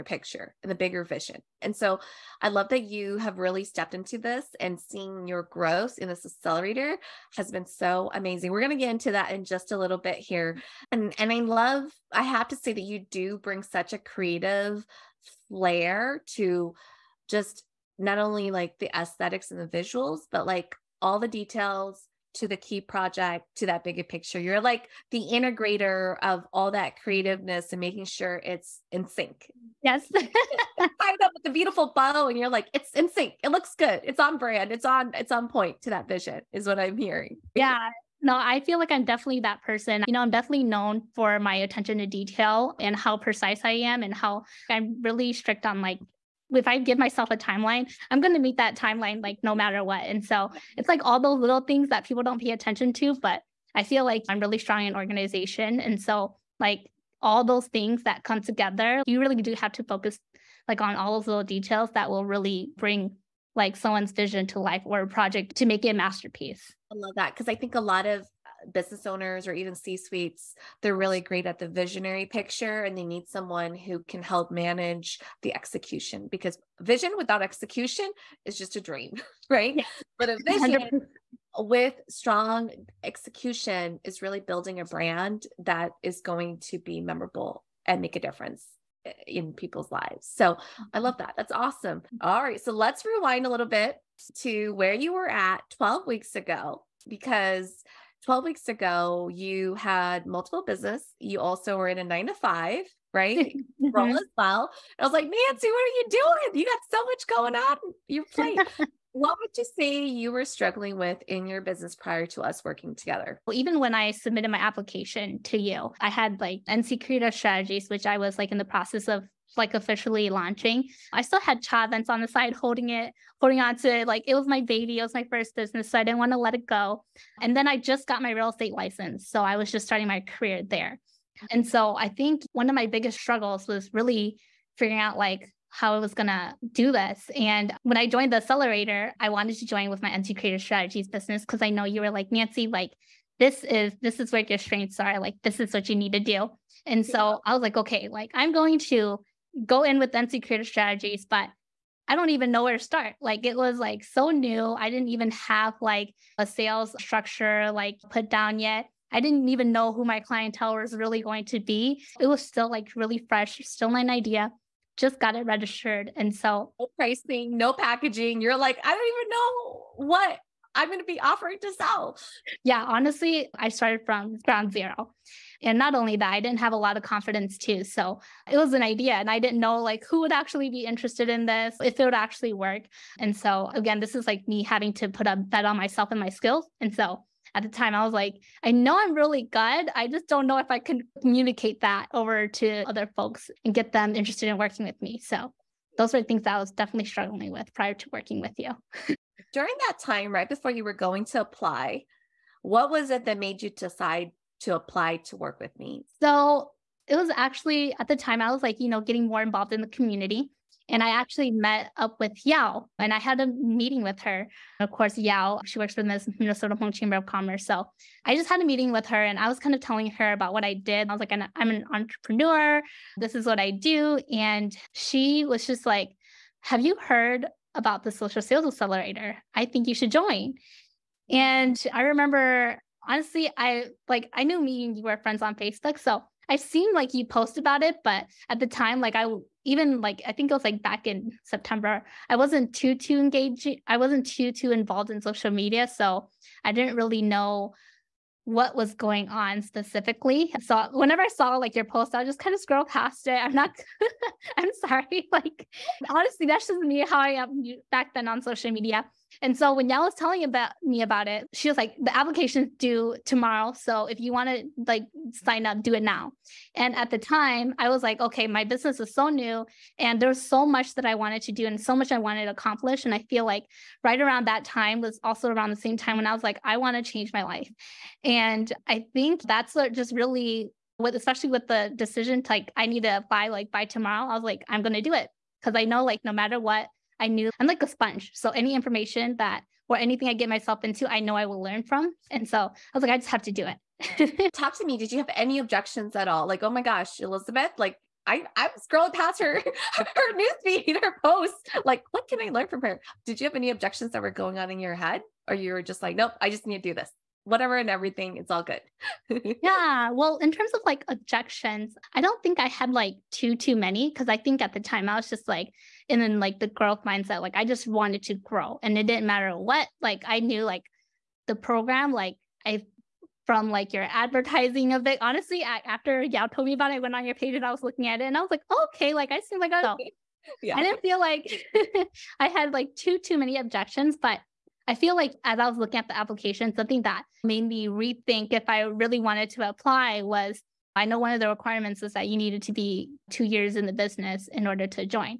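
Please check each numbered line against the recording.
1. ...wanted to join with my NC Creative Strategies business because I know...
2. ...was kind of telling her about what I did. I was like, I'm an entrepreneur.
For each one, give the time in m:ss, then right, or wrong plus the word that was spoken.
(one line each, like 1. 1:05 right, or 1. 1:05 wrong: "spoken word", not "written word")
1. 2:19 right
2. 3:39 right.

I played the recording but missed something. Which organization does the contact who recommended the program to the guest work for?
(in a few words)
Minnesota Hmong Chamber of Commerce.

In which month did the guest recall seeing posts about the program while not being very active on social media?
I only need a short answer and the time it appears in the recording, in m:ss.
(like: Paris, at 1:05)
September, at 4:01.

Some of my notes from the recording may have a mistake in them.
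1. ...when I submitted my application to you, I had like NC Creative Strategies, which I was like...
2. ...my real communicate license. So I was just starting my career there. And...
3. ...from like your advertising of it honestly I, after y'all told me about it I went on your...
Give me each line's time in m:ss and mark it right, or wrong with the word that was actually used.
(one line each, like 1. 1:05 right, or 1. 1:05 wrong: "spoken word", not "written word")
1. 1:53 right
2. 2:08 wrong: "estate", not "communicate"
3. 5:23 right.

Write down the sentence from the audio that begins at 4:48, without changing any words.
So any information that or anything I get myself into, I know I will learn from.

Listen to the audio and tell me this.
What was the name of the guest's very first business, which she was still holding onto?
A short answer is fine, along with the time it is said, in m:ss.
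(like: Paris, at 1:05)
cha events, at 2:01.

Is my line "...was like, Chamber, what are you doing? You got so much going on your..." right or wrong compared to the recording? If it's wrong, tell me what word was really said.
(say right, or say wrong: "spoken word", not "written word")
wrong: "Nancy", not "Chamber".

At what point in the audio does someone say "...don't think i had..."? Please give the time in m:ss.
5:12.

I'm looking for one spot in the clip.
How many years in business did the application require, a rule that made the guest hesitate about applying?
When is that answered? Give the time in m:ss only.
5:43.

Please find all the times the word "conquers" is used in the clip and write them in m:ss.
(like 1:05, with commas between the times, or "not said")
not said.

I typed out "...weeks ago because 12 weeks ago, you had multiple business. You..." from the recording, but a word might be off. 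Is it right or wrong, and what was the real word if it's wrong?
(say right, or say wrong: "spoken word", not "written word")
right.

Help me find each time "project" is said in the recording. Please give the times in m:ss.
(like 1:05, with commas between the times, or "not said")
0:22, 1:05.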